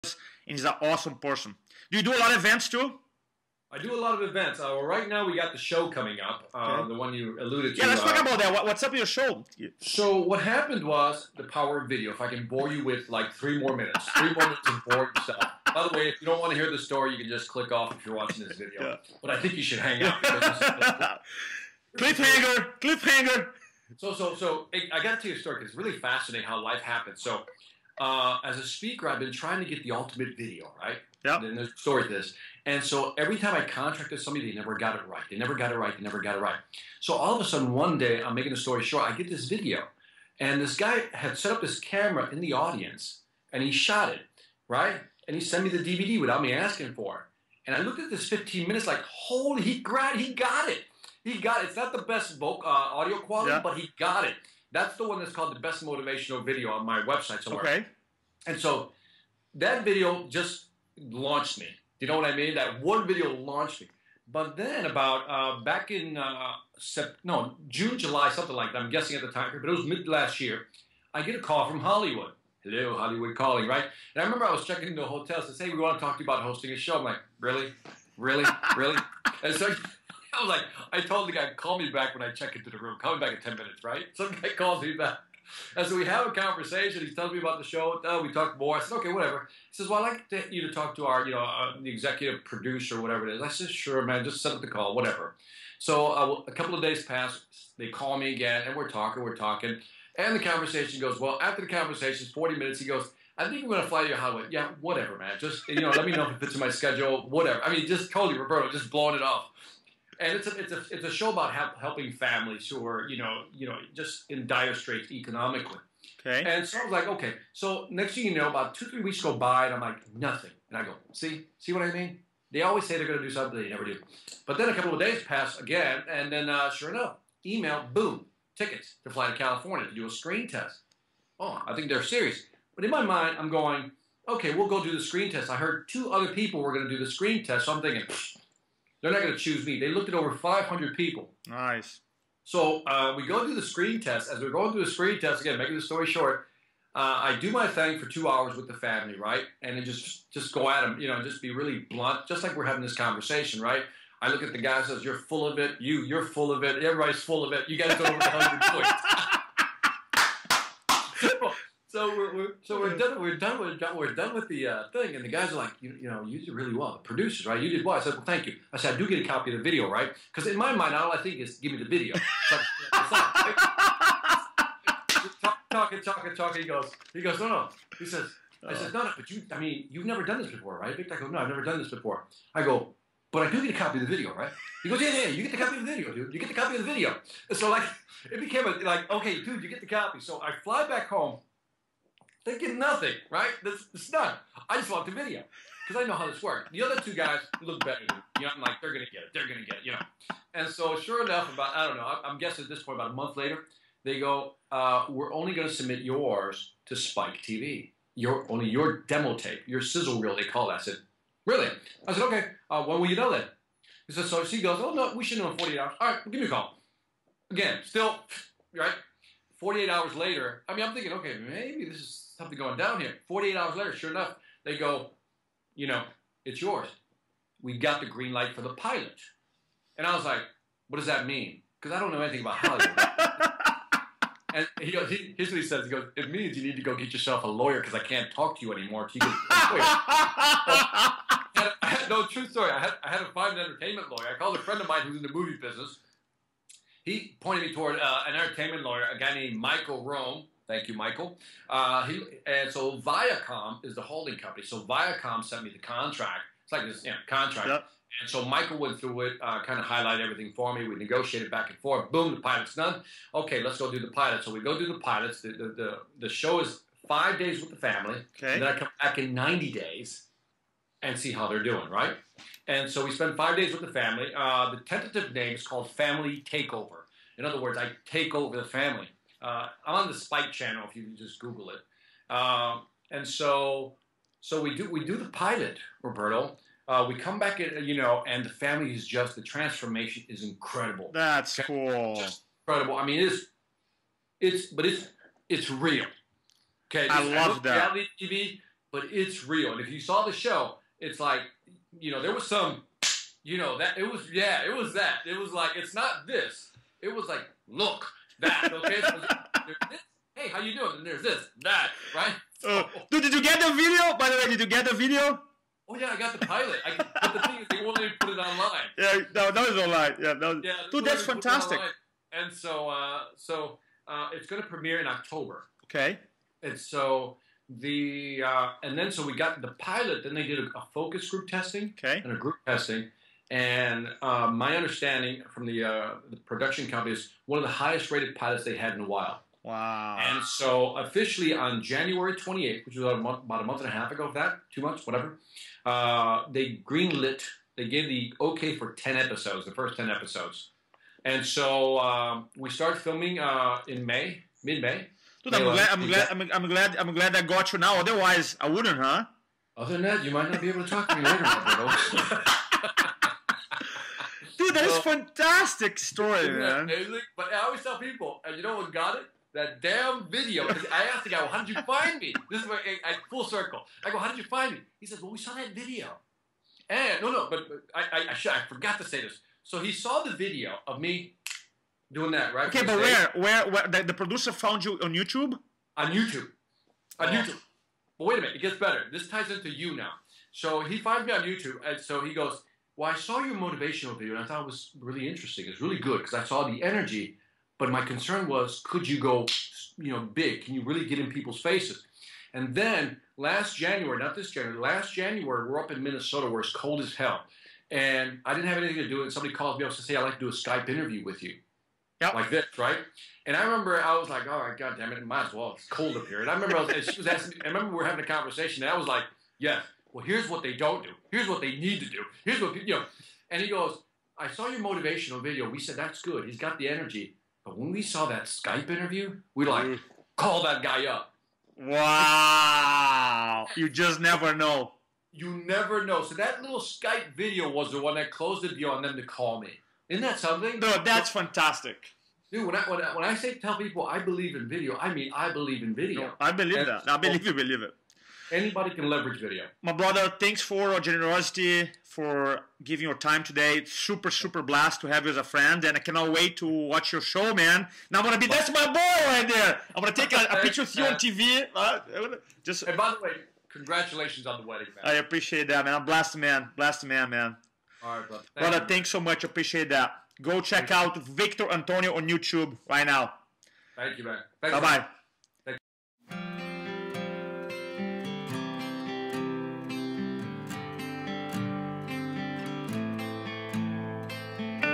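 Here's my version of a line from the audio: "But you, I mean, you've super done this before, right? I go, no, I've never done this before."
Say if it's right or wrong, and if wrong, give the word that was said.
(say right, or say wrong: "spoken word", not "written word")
wrong: "never", not "super".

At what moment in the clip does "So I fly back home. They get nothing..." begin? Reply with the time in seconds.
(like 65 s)
190 s.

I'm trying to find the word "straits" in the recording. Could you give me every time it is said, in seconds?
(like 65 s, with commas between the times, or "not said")
114 s.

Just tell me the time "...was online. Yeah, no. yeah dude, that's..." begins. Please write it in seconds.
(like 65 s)
319 s.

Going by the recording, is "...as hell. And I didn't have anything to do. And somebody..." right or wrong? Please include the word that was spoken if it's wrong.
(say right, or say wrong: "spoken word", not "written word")
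right.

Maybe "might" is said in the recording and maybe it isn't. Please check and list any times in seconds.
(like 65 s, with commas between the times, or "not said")
360 s, 415 s.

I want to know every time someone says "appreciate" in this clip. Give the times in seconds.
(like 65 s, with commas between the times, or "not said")
465 s, 469 s.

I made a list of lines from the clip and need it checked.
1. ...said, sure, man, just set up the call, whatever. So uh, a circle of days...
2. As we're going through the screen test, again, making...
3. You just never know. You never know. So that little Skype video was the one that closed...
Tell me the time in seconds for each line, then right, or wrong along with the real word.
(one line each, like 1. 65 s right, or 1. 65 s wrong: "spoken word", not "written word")
1. 93 s wrong: "couple", not "circle"
2. 144 s right
3. 433 s right.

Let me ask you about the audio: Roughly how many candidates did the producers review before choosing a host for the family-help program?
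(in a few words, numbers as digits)
500.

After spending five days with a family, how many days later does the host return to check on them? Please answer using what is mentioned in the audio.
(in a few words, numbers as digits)
90.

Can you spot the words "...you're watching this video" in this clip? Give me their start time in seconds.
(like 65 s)
18 s.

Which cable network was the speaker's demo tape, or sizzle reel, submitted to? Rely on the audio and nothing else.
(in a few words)
Spike TV.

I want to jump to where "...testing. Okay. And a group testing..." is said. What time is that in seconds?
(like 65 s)
331 s.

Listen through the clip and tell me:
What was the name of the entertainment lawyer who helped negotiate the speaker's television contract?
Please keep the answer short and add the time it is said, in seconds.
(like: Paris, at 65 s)
Michael Rome, at 249 s.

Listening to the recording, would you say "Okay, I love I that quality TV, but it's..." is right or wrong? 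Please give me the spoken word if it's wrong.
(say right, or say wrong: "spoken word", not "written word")
wrong: "reality", not "quality".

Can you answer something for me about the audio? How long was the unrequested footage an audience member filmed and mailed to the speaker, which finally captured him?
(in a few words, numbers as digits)
15 minutes.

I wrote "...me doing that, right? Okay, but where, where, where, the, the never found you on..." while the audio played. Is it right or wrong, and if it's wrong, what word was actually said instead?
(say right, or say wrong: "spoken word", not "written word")
wrong: "producer", not "never".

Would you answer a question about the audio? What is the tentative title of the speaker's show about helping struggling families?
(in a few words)
Family Takeover.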